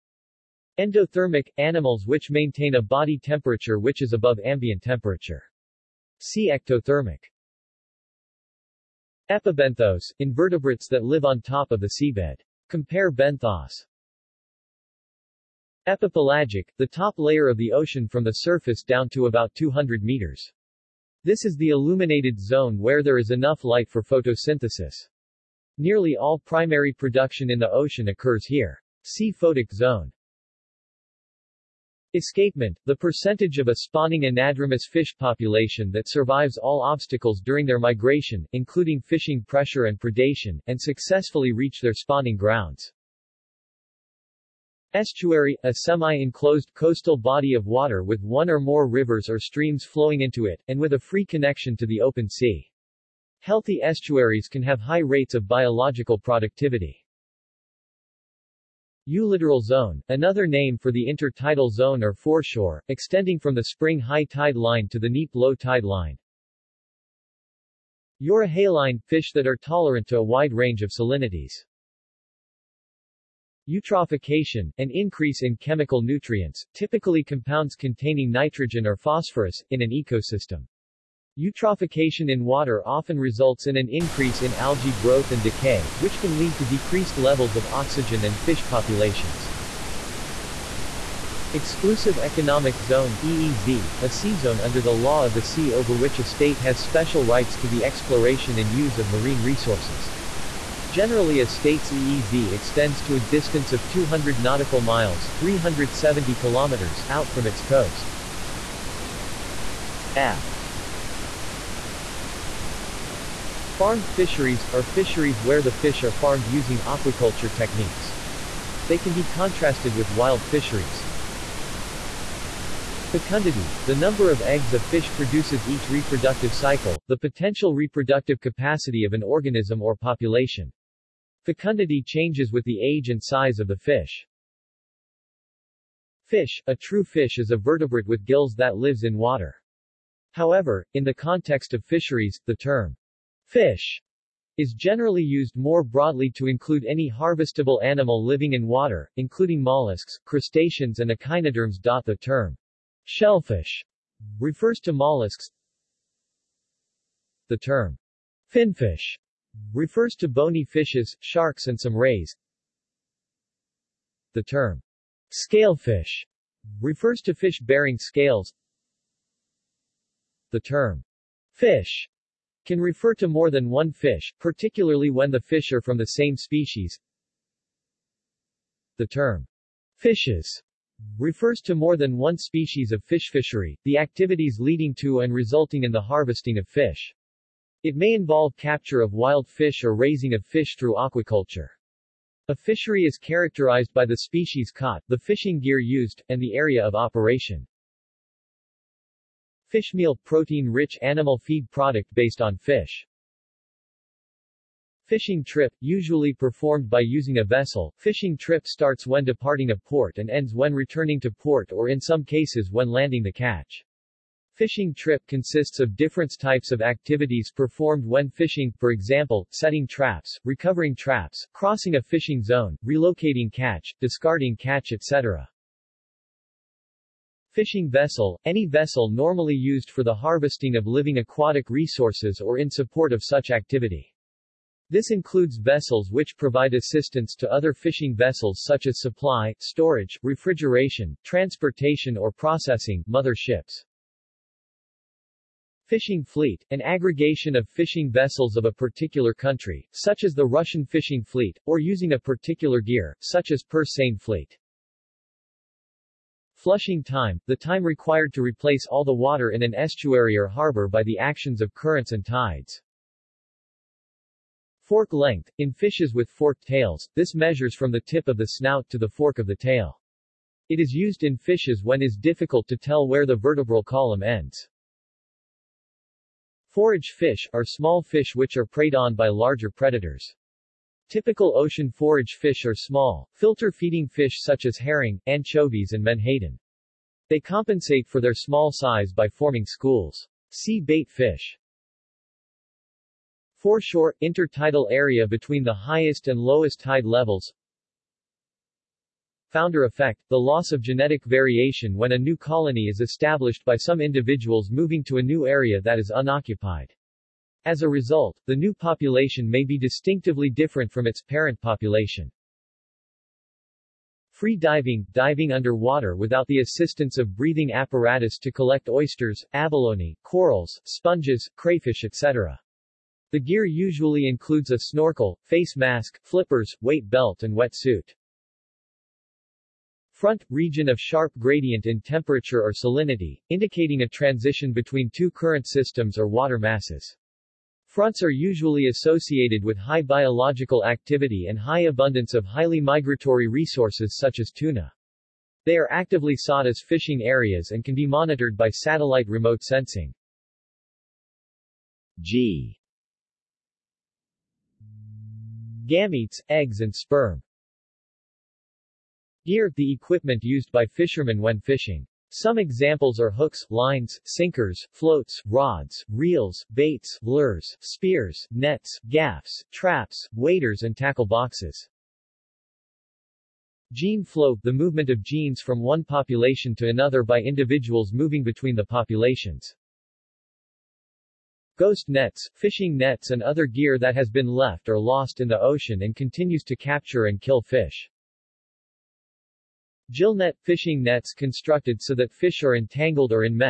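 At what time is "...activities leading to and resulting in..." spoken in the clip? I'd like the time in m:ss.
3:03.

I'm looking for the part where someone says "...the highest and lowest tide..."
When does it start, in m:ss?
4:55.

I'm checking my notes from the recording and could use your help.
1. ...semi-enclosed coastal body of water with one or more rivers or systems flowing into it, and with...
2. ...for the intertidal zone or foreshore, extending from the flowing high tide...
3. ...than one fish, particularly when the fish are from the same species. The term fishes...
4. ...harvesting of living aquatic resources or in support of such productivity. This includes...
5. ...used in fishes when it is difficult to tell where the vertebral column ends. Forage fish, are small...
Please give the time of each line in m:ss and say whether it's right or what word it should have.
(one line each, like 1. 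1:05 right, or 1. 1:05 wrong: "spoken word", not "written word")
1. 0:45 wrong: "streams", not "systems"
2. 1:00 wrong: "spring", not "flowing"
3. 2:53 right
4. 3:50 wrong: "activity", not "productivity"
5. 4:30 right.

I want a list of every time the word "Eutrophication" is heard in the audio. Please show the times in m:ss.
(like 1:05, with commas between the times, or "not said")
1:13, 1:21.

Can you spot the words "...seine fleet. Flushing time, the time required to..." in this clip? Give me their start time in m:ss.
4:13.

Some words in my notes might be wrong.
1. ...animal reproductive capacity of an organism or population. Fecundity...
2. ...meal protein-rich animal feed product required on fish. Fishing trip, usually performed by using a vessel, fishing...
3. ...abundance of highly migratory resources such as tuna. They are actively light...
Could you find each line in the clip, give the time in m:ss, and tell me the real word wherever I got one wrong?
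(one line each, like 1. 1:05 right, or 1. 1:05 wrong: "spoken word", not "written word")
1. 2:07 wrong: "potential", not "animal"
2. 3:19 wrong: "based", not "required"
3. 5:41 wrong: "sought", not "light".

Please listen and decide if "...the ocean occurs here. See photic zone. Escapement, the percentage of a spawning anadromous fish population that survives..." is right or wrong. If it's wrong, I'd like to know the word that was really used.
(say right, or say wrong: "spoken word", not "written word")
right.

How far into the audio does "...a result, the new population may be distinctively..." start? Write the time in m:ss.
5:07.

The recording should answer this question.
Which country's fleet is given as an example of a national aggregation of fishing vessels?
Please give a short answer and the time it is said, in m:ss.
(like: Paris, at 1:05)
Russian, at 4:10.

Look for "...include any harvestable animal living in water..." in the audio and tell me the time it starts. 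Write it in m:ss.
2:26.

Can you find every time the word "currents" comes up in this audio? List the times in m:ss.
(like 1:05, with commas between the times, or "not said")
4:21, 5:35.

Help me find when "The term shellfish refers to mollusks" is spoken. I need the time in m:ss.
2:31.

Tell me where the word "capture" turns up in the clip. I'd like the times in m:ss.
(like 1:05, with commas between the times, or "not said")
3:08, 6:26.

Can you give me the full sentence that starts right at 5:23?
The gear usually includes a snorkel, face mask, flippers, weight belt and wetsuit.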